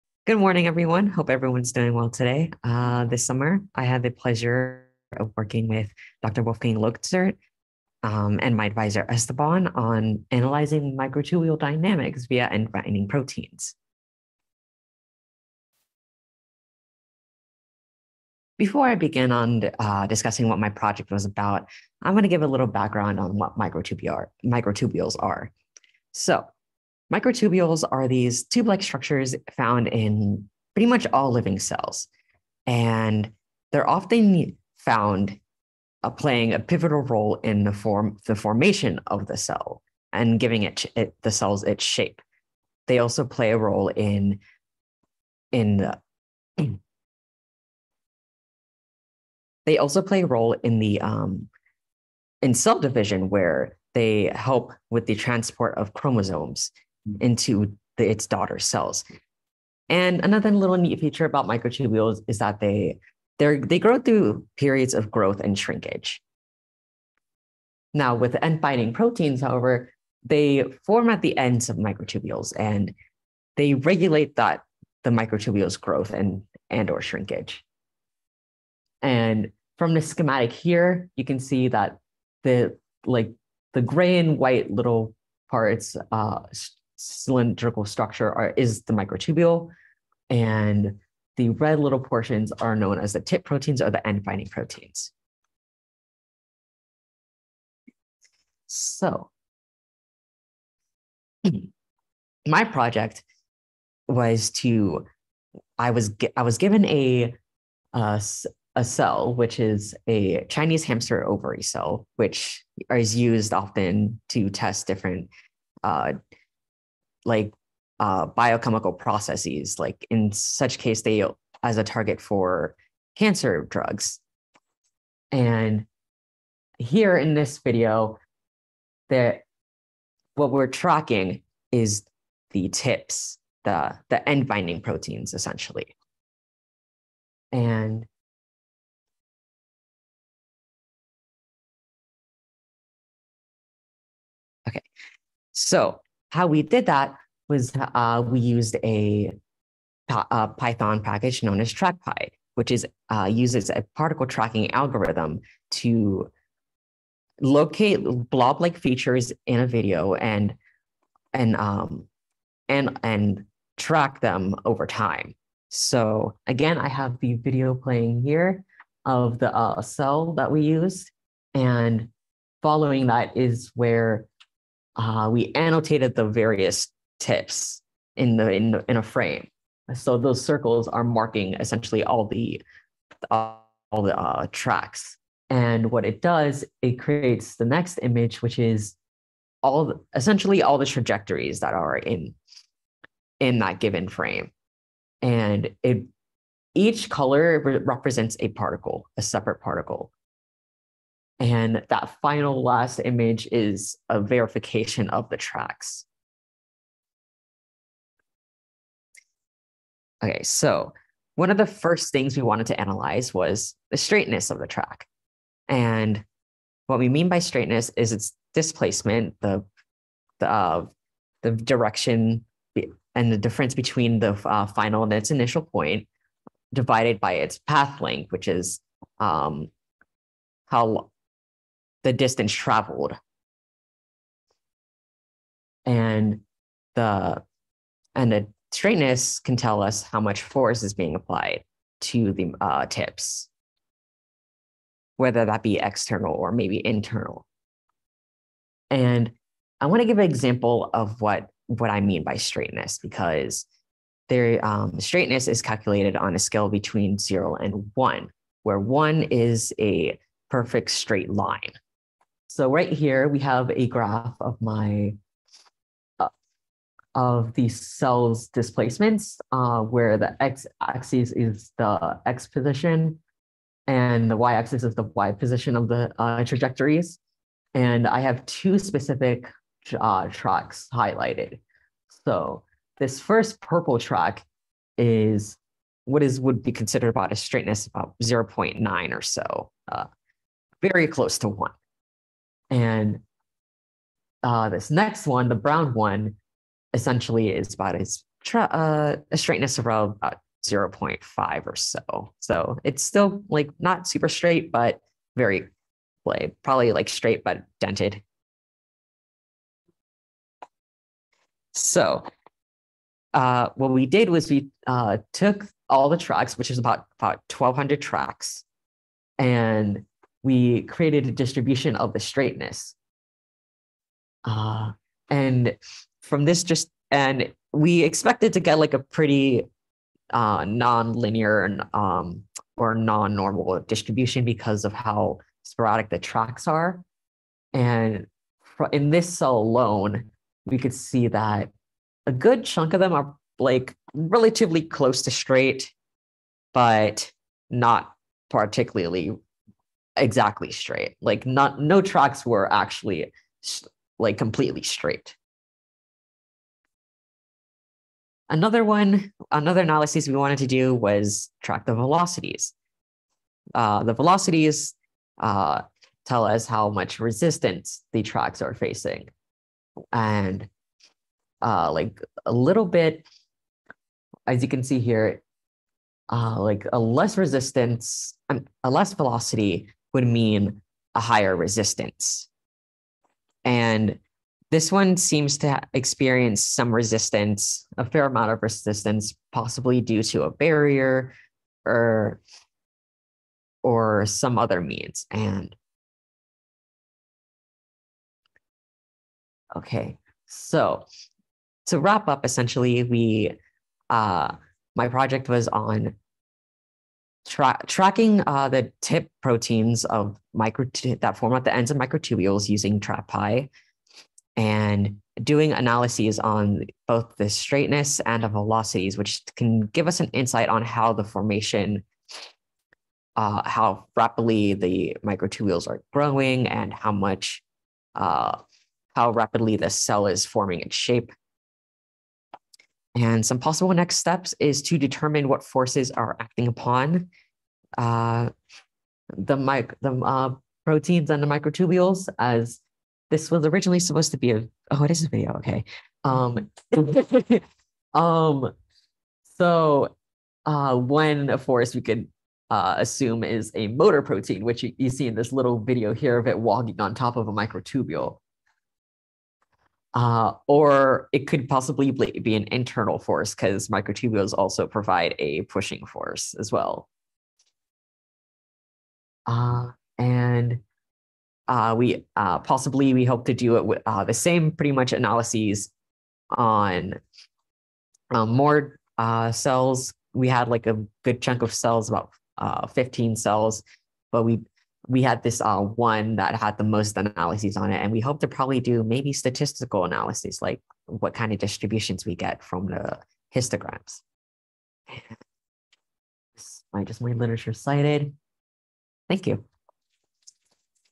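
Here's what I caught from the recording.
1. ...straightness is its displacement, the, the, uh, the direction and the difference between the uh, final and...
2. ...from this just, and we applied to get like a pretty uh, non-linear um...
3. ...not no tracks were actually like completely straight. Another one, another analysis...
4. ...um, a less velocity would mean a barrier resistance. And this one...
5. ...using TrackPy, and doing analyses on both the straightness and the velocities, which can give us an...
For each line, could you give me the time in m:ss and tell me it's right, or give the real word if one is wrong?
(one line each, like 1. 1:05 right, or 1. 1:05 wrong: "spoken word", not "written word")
1. 3:37 right
2. 5:26 wrong: "expected", not "applied"
3. 5:51 right
4. 6:18 wrong: "higher", not "barrier"
5. 6:52 right.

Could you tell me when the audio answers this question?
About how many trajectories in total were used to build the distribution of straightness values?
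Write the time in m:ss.
5:17.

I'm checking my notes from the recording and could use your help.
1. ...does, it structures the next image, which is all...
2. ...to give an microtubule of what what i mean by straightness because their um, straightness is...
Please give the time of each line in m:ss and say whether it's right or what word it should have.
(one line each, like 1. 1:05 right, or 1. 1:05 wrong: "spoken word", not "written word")
1. 3:06 wrong: "creates", not "structures"
2. 4:10 wrong: "example", not "microtubule".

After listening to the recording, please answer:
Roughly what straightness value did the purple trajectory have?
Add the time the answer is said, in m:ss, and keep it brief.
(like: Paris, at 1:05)
0.9, at 4:48.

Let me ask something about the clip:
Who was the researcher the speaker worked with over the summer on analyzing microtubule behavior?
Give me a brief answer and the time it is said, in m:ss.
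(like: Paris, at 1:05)
Dr. Wolfgang Losert, at 0:06.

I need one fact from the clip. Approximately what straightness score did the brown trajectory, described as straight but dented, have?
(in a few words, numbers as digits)
0.5.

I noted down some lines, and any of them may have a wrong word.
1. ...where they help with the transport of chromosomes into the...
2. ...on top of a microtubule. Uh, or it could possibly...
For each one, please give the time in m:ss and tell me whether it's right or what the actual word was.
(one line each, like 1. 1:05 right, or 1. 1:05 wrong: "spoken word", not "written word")
1. 0:53 right
2. 7:36 right.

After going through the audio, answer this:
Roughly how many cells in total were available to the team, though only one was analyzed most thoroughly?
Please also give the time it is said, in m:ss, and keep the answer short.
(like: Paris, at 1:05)
15, at 8:02.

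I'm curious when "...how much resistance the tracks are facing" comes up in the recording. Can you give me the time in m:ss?
6:06.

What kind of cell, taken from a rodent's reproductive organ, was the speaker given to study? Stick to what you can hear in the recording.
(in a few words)
Chinese hamster ovary cell.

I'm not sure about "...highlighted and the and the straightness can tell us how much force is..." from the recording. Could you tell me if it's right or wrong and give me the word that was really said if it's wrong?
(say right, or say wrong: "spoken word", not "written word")
wrong: "traveled", not "highlighted".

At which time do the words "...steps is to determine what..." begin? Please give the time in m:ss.
7:14.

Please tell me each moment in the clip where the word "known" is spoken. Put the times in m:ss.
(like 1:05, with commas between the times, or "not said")
1:32, 2:31.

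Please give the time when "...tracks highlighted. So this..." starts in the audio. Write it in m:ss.
4:40.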